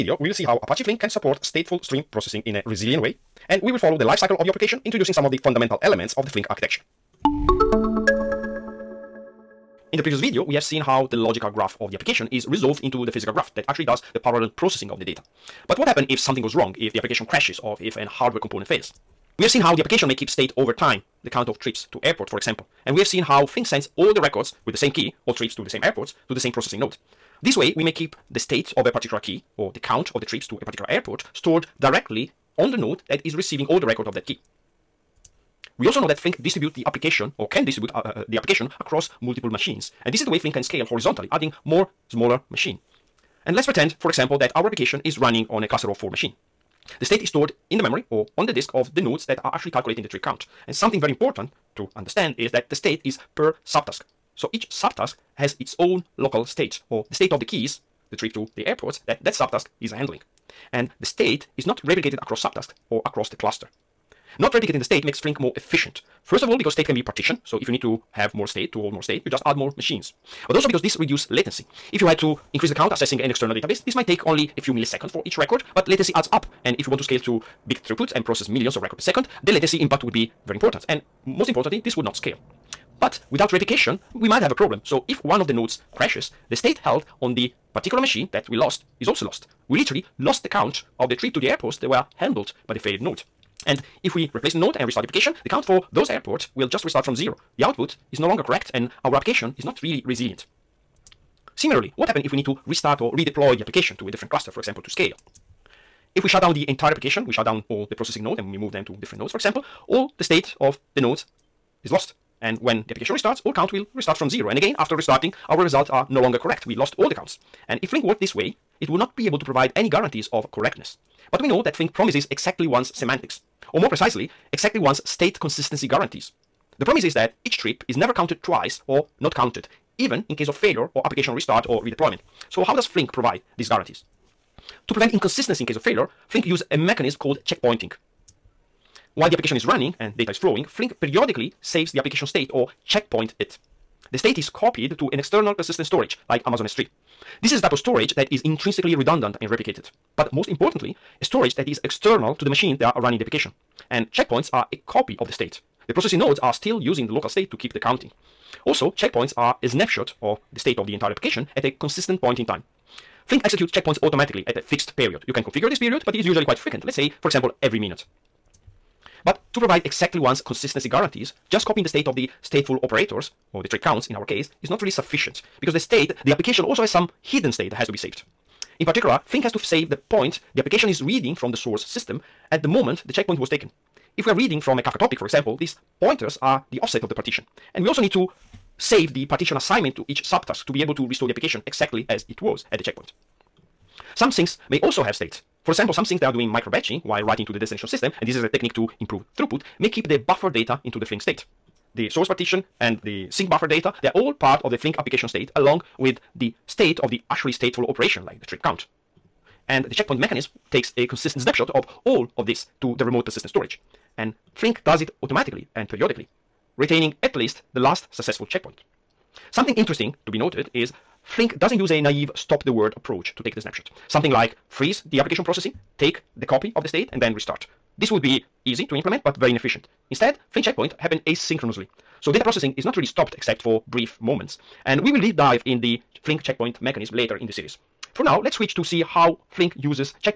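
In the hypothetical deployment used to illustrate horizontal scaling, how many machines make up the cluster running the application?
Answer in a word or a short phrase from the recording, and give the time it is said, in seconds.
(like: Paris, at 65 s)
4, at 45 s.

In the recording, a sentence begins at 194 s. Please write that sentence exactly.
Some things may also have state.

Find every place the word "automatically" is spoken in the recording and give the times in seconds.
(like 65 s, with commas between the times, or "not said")
164 s, 215 s.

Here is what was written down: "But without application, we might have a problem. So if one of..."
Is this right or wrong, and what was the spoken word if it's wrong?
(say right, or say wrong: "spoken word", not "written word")
wrong: "replication", not "application".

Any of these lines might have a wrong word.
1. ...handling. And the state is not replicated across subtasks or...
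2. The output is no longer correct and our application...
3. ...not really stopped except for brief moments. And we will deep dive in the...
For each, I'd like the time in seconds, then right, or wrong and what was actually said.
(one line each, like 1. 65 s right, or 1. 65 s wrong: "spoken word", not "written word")
1. 59 s right
2. 97 s right
3. 232 s right.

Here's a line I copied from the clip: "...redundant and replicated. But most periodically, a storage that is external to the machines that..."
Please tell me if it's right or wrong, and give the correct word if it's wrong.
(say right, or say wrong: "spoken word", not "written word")
wrong: "importantly", not "periodically".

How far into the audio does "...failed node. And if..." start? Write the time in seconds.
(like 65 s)
92 s.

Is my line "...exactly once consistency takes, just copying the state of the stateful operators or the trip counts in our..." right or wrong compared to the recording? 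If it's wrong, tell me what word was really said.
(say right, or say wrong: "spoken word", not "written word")
wrong: "guarantees", not "takes".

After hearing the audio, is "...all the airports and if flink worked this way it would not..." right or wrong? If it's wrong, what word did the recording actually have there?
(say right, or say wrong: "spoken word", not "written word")
wrong: "counts", not "airports".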